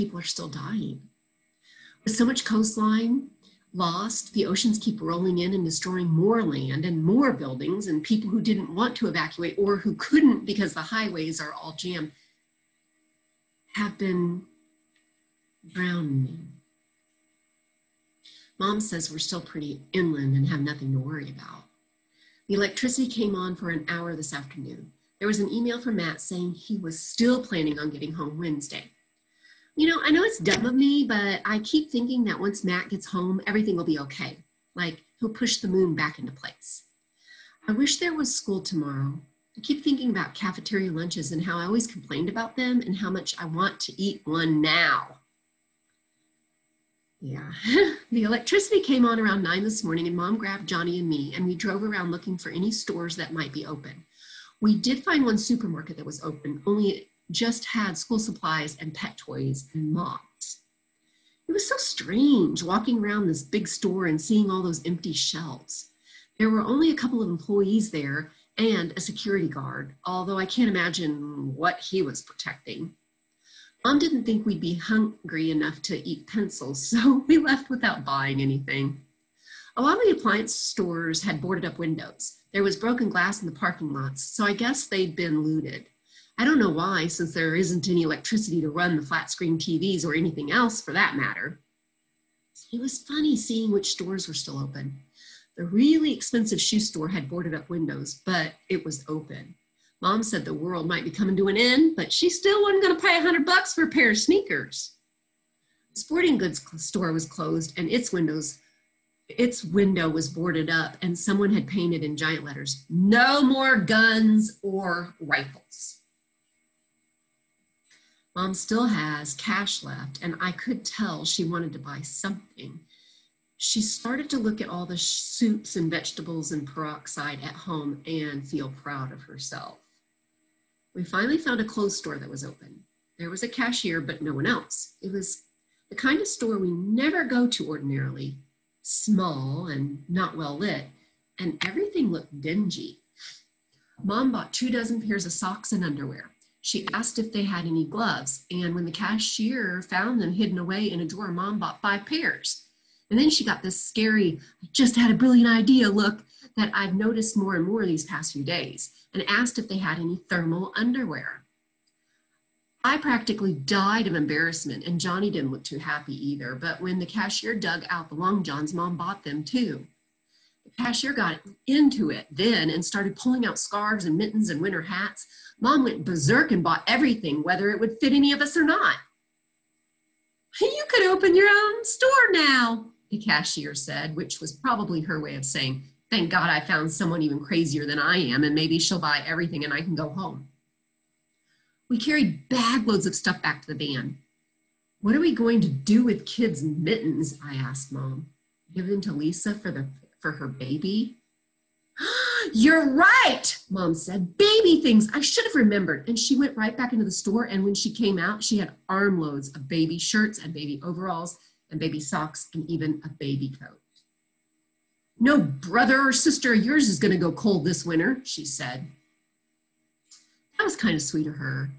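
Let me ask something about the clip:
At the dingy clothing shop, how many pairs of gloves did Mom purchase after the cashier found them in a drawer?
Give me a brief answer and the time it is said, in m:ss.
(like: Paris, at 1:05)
5, at 2:31.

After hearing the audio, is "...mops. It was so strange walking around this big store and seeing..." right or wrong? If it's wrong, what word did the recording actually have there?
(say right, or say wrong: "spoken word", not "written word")
right.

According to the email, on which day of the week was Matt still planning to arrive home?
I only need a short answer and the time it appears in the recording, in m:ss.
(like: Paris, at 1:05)
Wednesday, at 0:28.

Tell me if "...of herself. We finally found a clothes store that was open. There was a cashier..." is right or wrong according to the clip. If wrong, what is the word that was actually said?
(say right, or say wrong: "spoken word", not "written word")
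right.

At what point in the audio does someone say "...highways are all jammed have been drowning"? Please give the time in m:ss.
0:10.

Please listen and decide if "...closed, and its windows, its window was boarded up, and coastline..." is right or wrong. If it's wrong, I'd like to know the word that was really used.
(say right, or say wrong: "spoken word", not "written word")
wrong: "someone", not "coastline".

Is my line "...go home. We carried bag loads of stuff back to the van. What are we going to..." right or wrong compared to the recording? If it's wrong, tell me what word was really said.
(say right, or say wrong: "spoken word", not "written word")
right.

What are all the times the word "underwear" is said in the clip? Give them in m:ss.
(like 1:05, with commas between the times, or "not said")
2:25, 2:40.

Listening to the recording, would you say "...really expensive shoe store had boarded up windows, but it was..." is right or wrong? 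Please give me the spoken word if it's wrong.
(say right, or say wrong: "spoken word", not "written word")
right.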